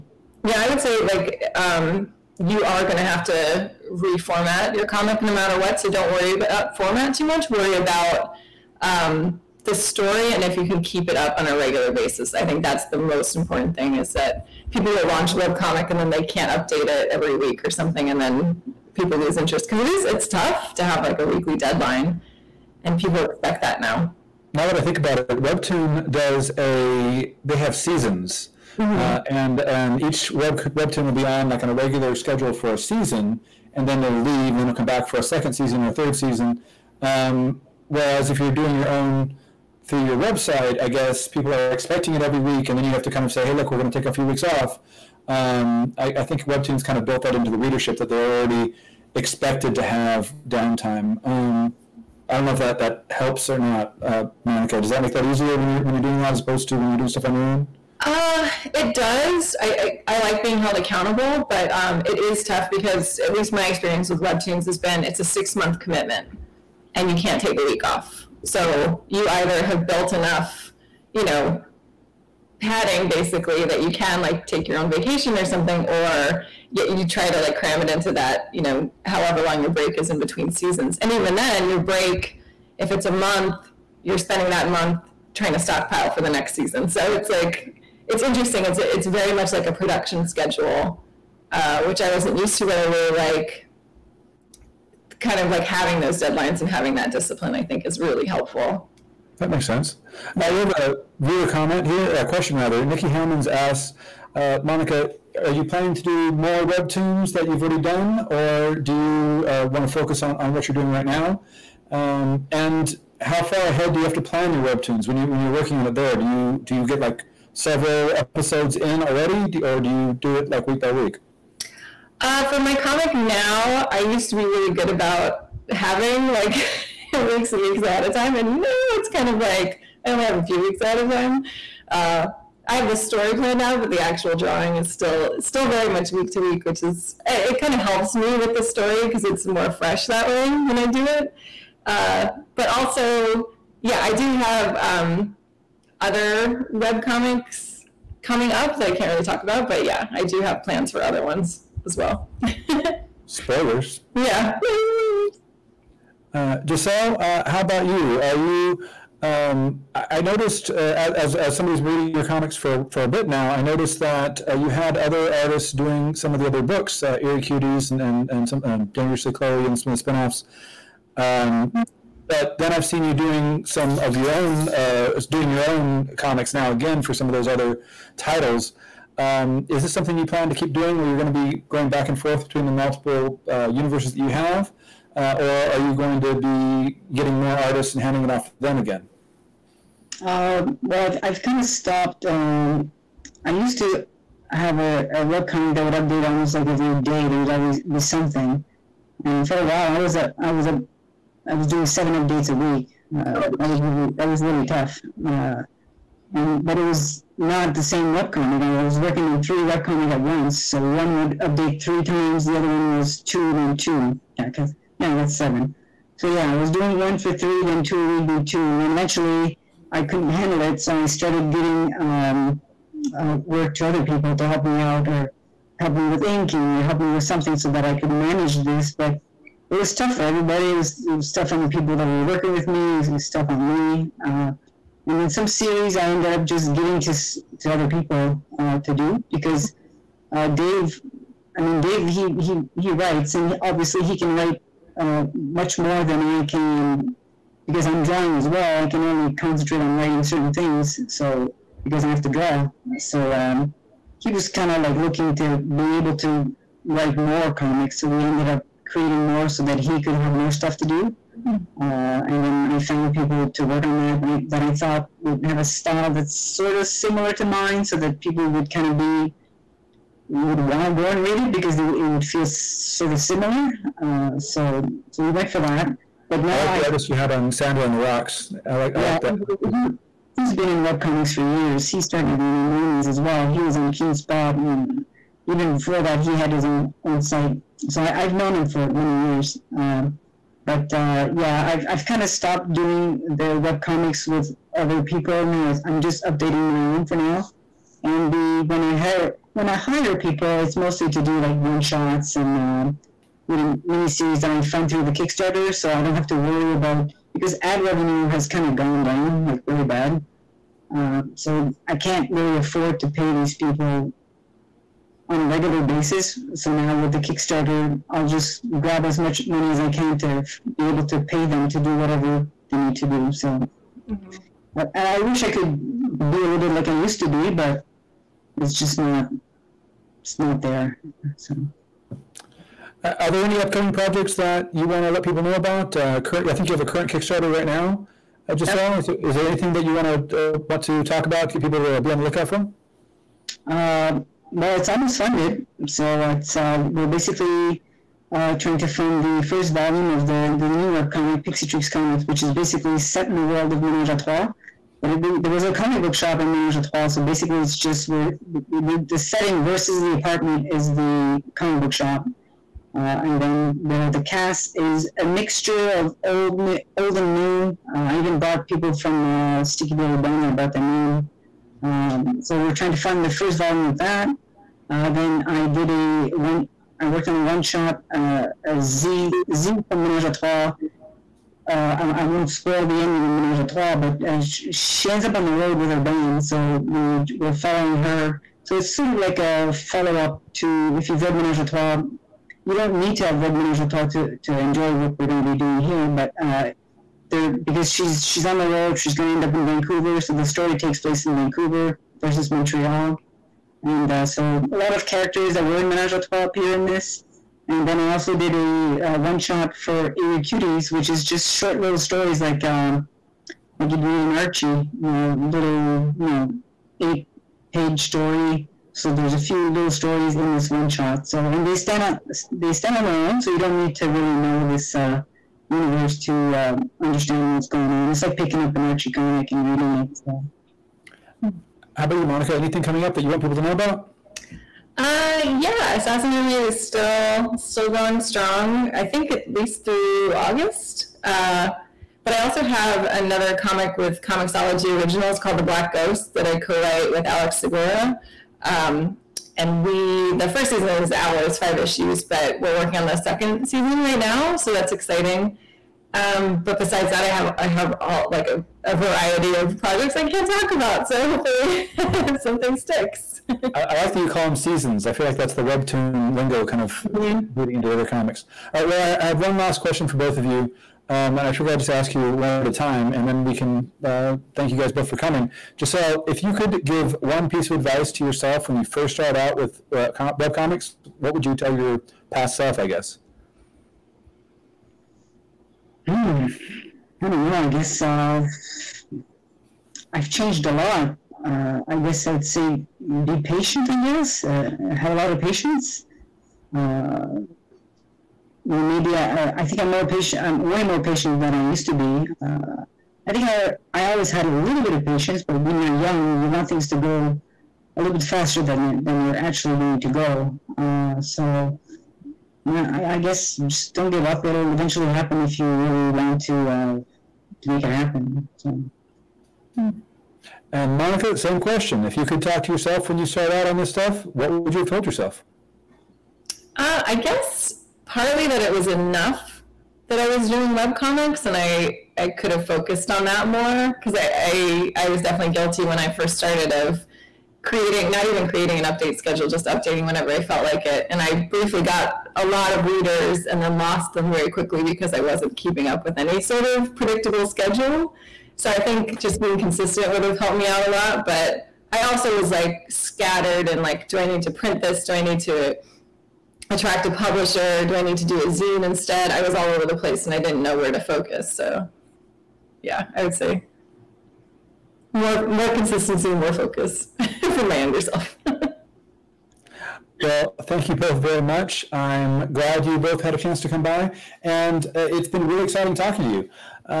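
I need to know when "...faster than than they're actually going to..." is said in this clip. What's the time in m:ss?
8:28.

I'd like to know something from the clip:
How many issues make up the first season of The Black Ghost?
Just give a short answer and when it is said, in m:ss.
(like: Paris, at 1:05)
5, at 7:31.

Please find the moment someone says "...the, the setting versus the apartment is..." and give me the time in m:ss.
5:58.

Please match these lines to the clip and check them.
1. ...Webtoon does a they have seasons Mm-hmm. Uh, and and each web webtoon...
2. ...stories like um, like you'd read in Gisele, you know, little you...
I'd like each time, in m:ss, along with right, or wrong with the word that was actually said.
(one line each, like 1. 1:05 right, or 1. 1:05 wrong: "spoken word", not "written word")
1. 0:25 right
2. 6:51 wrong: "Archie", not "Gisele".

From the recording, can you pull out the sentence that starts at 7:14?
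Uh, yeah, Assassin Roommate is still still going strong.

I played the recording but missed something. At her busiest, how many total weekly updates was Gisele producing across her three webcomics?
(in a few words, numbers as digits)
7.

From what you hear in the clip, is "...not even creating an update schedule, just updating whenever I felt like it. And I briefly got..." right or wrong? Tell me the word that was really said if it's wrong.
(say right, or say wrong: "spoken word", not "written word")
right.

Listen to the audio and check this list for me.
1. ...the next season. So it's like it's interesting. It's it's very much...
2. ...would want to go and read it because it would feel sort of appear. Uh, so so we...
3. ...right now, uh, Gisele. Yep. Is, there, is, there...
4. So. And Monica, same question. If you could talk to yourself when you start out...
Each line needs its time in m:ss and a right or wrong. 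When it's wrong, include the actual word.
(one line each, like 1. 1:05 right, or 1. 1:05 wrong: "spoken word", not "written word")
1. 1:26 right
2. 4:30 wrong: "similar", not "appear"
3. 5:37 right
4. 8:38 right.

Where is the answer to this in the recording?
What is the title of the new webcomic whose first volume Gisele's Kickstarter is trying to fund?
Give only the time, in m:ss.
5:51.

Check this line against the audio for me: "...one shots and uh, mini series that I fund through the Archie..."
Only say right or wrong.
wrong.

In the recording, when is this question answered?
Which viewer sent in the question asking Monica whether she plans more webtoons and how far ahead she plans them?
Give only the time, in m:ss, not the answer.
1:42.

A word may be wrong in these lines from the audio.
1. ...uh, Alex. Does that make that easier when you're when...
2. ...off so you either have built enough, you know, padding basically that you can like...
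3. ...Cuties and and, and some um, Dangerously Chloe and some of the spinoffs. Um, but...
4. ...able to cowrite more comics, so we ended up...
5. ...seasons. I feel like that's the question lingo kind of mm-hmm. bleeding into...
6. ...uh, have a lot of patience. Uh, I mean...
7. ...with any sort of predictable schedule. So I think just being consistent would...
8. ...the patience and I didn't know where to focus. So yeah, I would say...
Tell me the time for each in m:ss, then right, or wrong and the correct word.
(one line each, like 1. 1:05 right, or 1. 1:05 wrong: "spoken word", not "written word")
1. 0:54 wrong: "Monica", not "Alex"
2. 1:07 right
3. 2:47 right
4. 4:15 wrong: "write", not "cowrite"
5. 7:44 wrong: "webtoon", not "question"
6. 8:14 right
7. 9:06 right
8. 9:19 wrong: "place", not "patience".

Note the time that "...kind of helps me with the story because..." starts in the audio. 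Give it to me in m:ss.
2:17.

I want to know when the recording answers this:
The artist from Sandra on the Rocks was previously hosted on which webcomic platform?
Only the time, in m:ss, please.
4:43.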